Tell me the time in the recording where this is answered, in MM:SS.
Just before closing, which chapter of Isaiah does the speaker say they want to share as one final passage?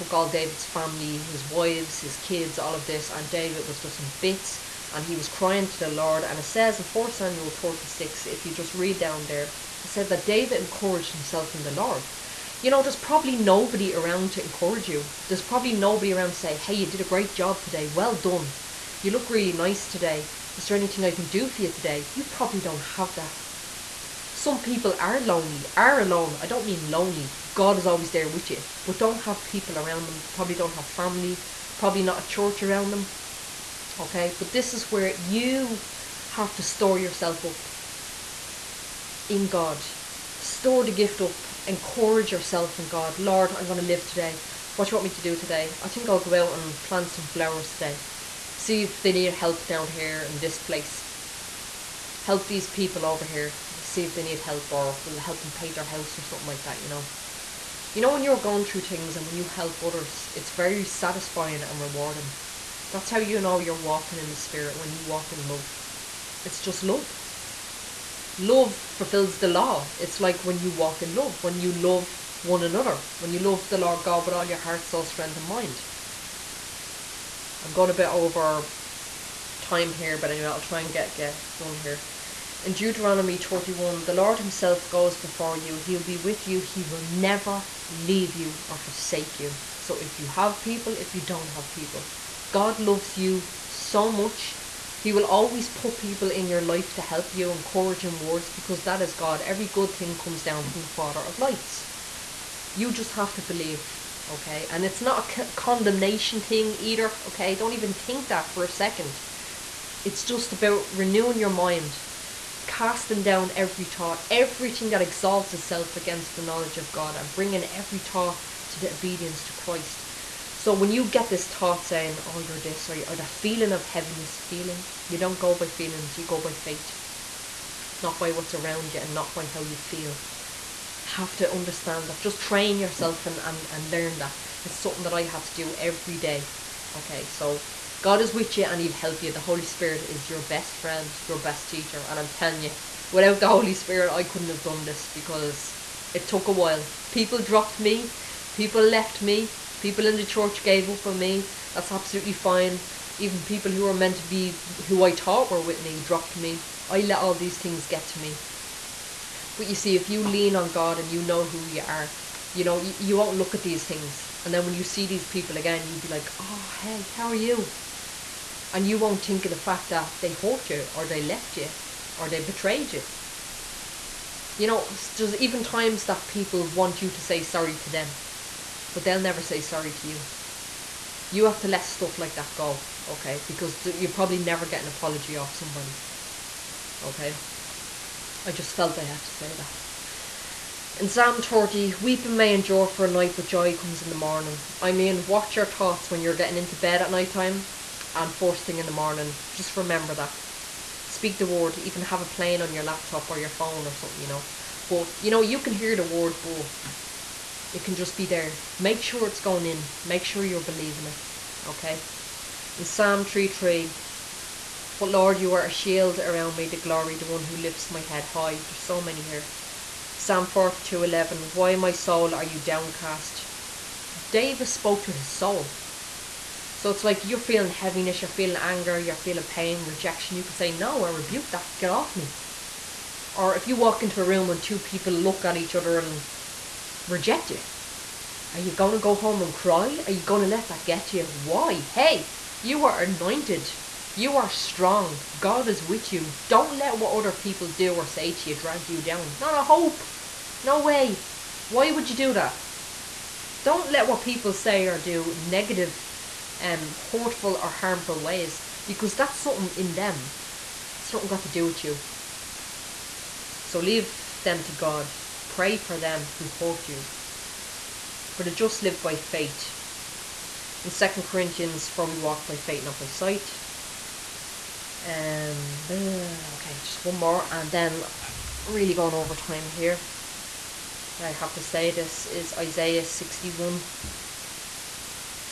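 04:42.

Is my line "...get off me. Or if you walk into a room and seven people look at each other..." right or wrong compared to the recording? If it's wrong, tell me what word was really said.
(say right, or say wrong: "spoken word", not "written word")
wrong: "two", not "seven".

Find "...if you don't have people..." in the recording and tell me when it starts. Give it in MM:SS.
01:30.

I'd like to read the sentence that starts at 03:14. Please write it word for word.
I mean, watch your thoughts when you're getting into bed at night time and first thing in the morning, just remember that.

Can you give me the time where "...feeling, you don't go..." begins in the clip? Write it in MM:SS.
02:04.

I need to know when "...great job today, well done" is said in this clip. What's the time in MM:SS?
00:17.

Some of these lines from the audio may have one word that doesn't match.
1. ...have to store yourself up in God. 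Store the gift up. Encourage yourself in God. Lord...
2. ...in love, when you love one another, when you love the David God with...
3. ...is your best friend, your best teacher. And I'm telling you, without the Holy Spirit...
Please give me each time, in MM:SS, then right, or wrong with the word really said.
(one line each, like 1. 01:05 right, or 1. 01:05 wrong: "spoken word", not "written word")
1. 00:36 right
2. 01:11 wrong: "Lord", not "David"
3. 02:20 right.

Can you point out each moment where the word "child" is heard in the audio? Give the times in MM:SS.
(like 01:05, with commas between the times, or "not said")
not said.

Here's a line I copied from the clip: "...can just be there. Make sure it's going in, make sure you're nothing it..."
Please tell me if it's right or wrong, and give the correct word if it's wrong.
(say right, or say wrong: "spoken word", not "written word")
wrong: "believing", not "nothing".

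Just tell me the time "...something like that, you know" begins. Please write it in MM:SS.
00:56.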